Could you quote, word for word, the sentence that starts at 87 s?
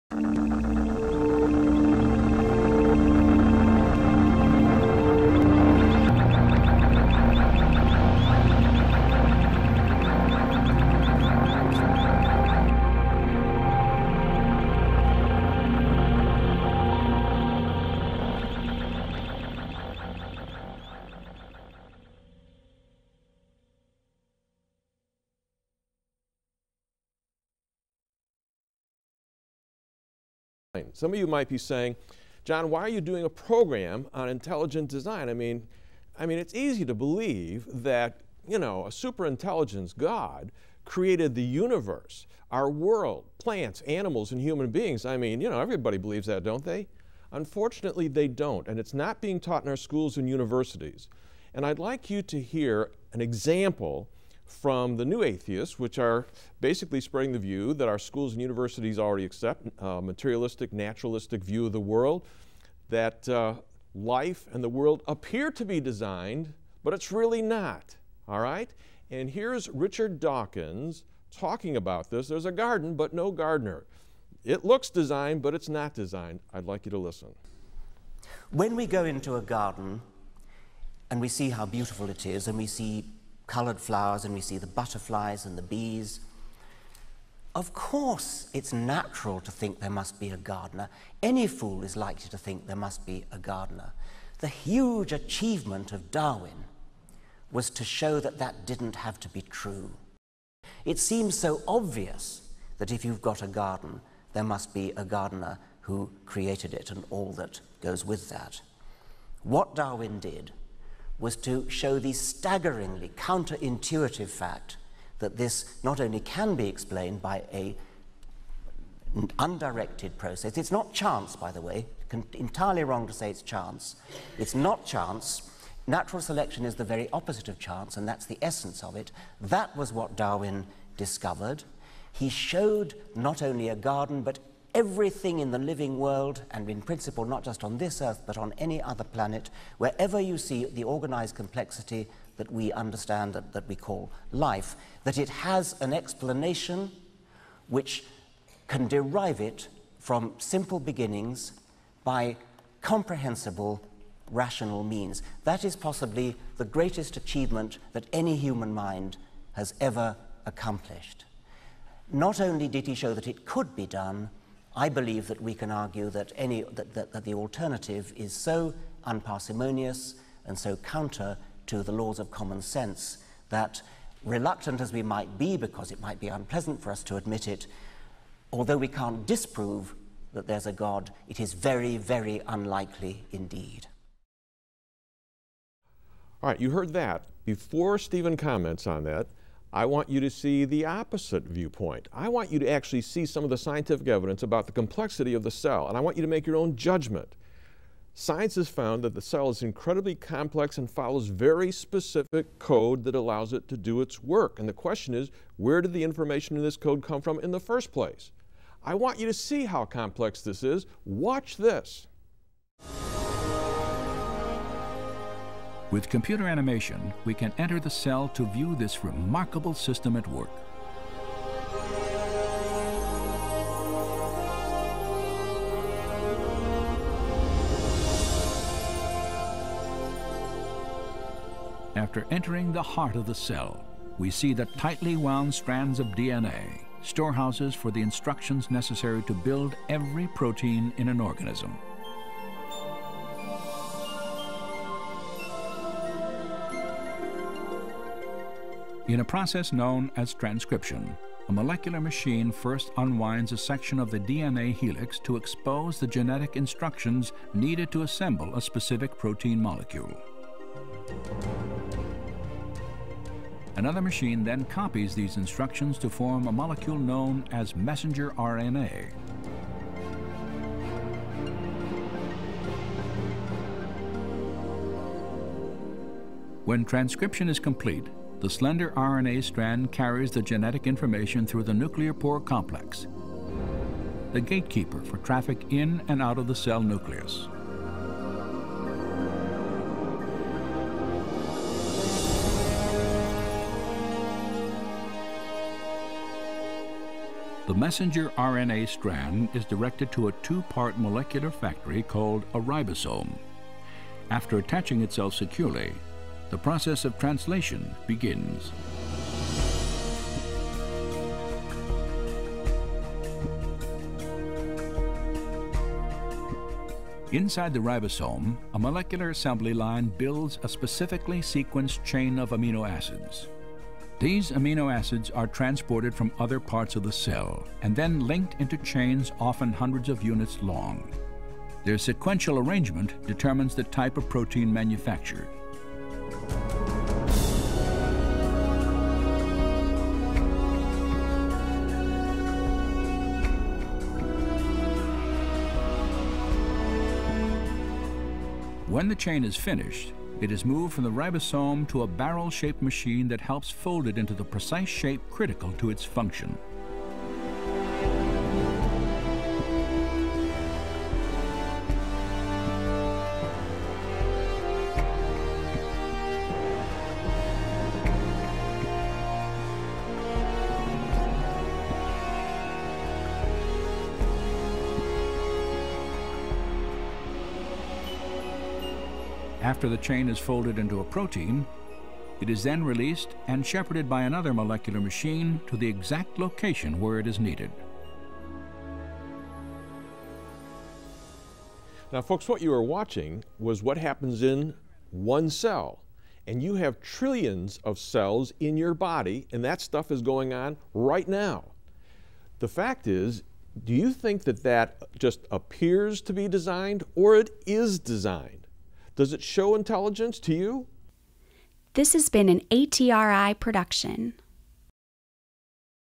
Of course, it's natural to think there must be a gardener.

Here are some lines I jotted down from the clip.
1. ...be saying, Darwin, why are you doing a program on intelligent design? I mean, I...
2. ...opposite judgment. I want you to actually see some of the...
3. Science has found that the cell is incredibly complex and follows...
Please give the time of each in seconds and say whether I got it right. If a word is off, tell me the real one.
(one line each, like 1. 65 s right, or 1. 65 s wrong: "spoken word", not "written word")
1. 31 s wrong: "John", not "Darwin"
2. 190 s wrong: "viewpoint", not "judgment"
3. 198 s right.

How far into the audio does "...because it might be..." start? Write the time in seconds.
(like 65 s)
175 s.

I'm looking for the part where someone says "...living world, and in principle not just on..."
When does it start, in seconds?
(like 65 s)
135 s.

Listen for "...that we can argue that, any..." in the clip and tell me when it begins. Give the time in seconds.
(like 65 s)
165 s.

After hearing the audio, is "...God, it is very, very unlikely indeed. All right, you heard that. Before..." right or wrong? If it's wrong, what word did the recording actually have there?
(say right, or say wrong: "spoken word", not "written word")
right.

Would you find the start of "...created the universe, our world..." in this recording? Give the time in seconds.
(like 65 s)
40 s.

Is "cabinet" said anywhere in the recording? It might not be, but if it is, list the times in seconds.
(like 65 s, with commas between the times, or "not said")
not said.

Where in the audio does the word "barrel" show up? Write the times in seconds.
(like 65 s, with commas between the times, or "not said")
352 s.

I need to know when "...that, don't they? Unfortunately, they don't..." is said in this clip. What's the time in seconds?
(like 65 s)
46 s.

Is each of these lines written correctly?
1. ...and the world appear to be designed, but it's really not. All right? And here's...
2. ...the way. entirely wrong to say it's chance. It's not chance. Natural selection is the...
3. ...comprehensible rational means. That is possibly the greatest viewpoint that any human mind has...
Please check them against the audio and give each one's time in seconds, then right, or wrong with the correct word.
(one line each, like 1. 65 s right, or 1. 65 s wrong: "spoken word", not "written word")
1. 64 s right
2. 121 s right
3. 152 s wrong: "achievement", not "viewpoint".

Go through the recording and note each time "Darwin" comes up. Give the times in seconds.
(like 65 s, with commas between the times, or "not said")
96 s, 109 s, 130 s.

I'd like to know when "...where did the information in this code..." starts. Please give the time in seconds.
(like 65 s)
205 s.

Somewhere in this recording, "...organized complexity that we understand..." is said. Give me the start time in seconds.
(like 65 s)
140 s.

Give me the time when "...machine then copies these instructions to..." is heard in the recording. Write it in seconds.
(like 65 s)
264 s.